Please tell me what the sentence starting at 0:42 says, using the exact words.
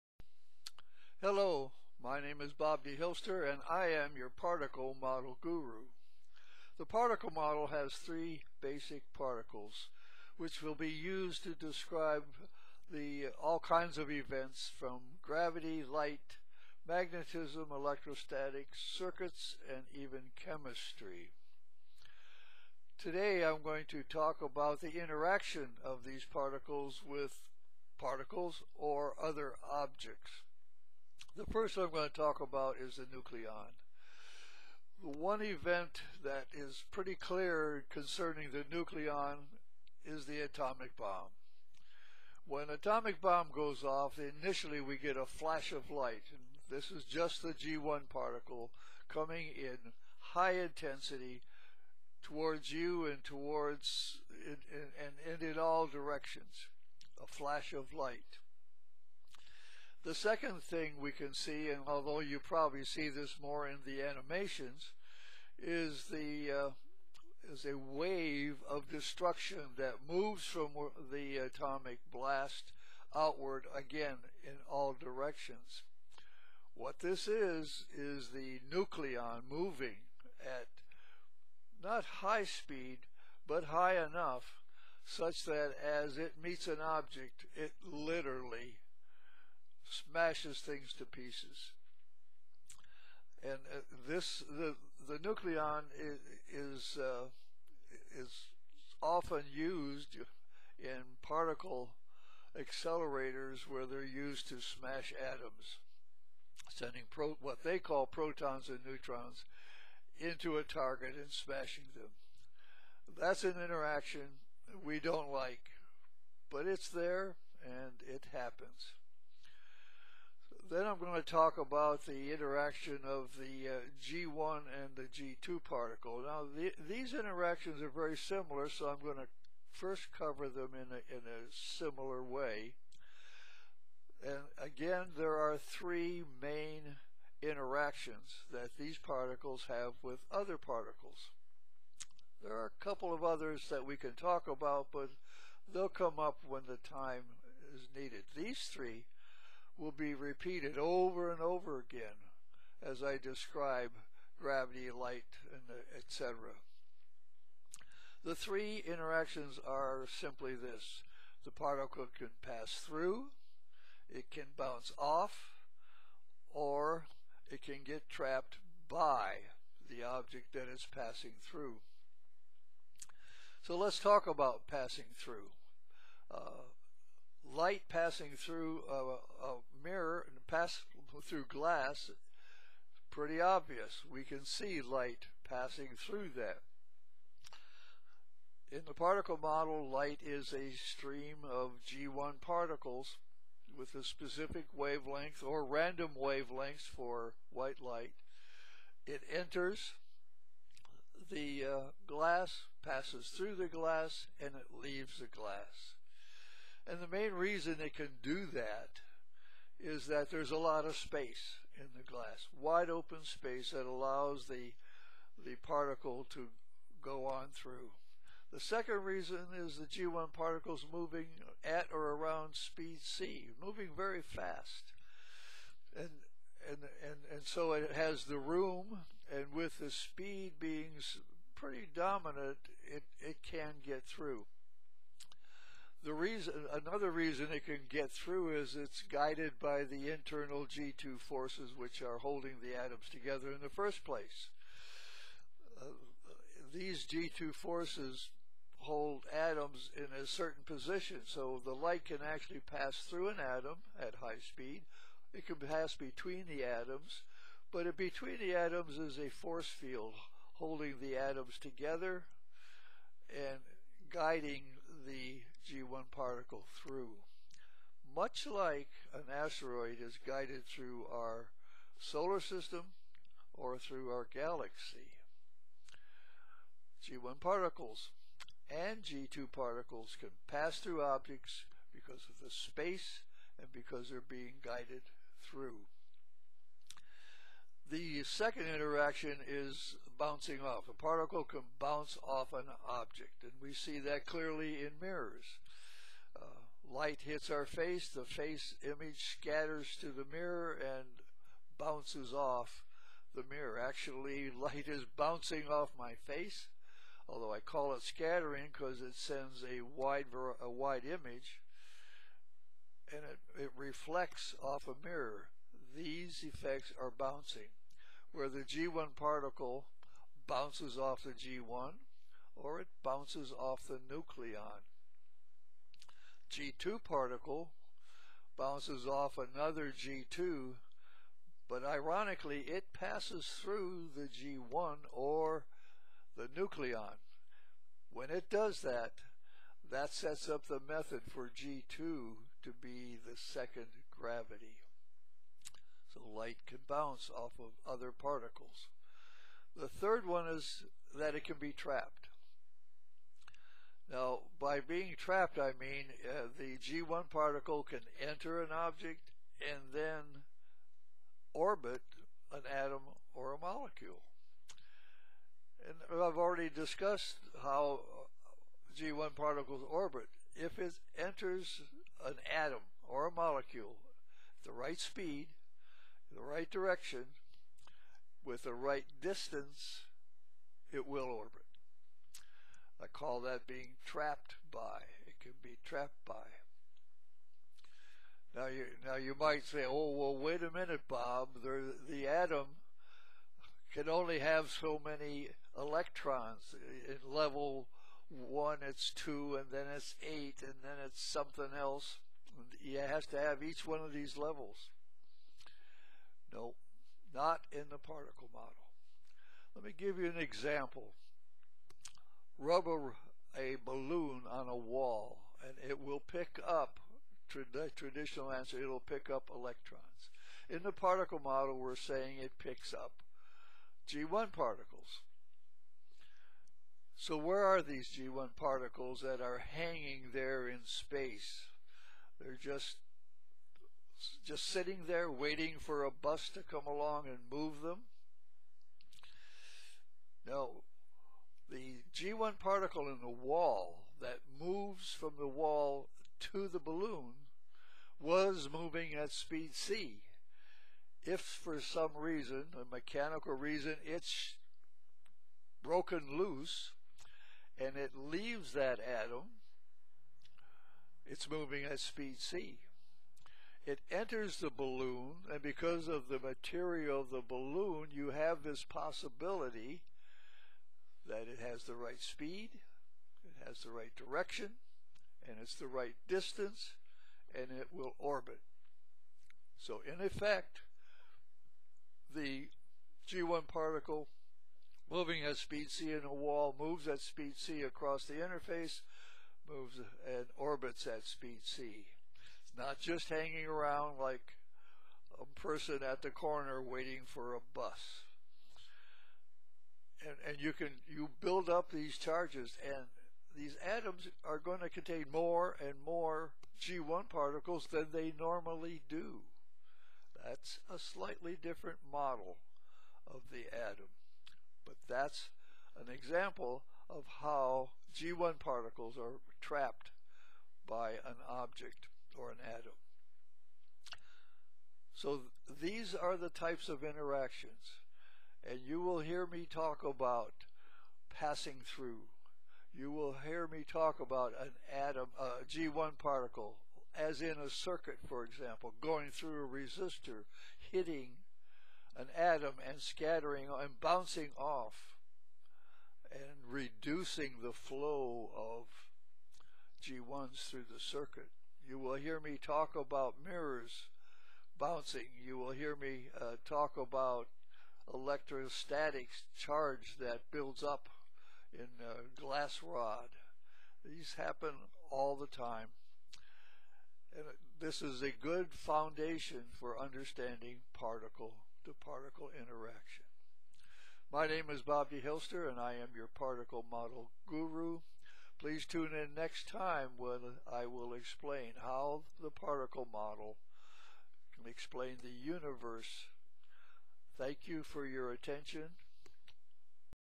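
When atomic bomb goes off, initially we get a flash of light.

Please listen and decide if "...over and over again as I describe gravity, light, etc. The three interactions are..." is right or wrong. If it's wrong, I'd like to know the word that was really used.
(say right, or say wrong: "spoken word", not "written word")
right.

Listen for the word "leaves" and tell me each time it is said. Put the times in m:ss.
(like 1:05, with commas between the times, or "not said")
3:24, 7:38.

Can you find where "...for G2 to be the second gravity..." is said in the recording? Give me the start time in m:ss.
5:41.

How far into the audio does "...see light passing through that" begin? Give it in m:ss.
3:04.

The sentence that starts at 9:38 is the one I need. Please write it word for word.
Please tune in next time when I will explain how the particle model can explain the universe.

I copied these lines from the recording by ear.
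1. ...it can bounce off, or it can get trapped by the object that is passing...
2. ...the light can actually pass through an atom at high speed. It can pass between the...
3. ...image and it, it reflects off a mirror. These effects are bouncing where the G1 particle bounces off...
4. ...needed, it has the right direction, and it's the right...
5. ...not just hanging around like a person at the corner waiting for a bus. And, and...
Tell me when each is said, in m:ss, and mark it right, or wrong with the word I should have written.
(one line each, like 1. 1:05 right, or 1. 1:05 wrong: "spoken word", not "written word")
1. 2:44 right
2. 4:11 right
3. 5:11 right
4. 7:52 wrong: "speed", not "needed"
5. 8:12 right.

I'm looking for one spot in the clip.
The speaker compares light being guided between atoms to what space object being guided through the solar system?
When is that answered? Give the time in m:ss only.
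4:29.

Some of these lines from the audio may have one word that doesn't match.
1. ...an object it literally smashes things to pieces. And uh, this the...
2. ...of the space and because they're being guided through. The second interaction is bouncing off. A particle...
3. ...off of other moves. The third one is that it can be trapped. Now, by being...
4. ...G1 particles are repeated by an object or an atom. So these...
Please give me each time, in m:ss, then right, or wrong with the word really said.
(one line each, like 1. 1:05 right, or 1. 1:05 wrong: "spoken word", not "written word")
1. 1:26 right
2. 4:42 right
3. 5:47 wrong: "particles", not "moves"
4. 8:38 wrong: "trapped", not "repeated".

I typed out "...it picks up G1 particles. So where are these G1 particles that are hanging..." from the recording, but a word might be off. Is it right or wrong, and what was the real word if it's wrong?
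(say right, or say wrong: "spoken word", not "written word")
right.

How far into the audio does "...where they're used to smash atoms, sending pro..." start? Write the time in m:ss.
1:43.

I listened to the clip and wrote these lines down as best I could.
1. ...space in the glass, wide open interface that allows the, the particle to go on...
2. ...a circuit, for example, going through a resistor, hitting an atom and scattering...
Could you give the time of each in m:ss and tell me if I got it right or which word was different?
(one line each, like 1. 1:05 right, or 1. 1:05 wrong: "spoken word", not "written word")
1. 3:30 wrong: "space", not "interface"
2. 8:57 right.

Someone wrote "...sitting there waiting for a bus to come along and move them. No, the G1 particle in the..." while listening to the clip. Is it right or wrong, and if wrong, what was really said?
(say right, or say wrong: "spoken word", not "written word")
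right.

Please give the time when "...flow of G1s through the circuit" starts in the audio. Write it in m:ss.
9:07.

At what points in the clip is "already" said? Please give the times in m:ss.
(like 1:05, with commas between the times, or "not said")
6:06.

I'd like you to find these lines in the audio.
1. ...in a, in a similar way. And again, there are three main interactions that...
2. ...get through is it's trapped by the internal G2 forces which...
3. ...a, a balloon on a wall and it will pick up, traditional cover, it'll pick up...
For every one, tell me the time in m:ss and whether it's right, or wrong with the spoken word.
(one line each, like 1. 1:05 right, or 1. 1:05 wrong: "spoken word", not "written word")
1. 2:10 right
2. 3:57 wrong: "guided", not "trapped"
3. 6:52 wrong: "answer", not "cover".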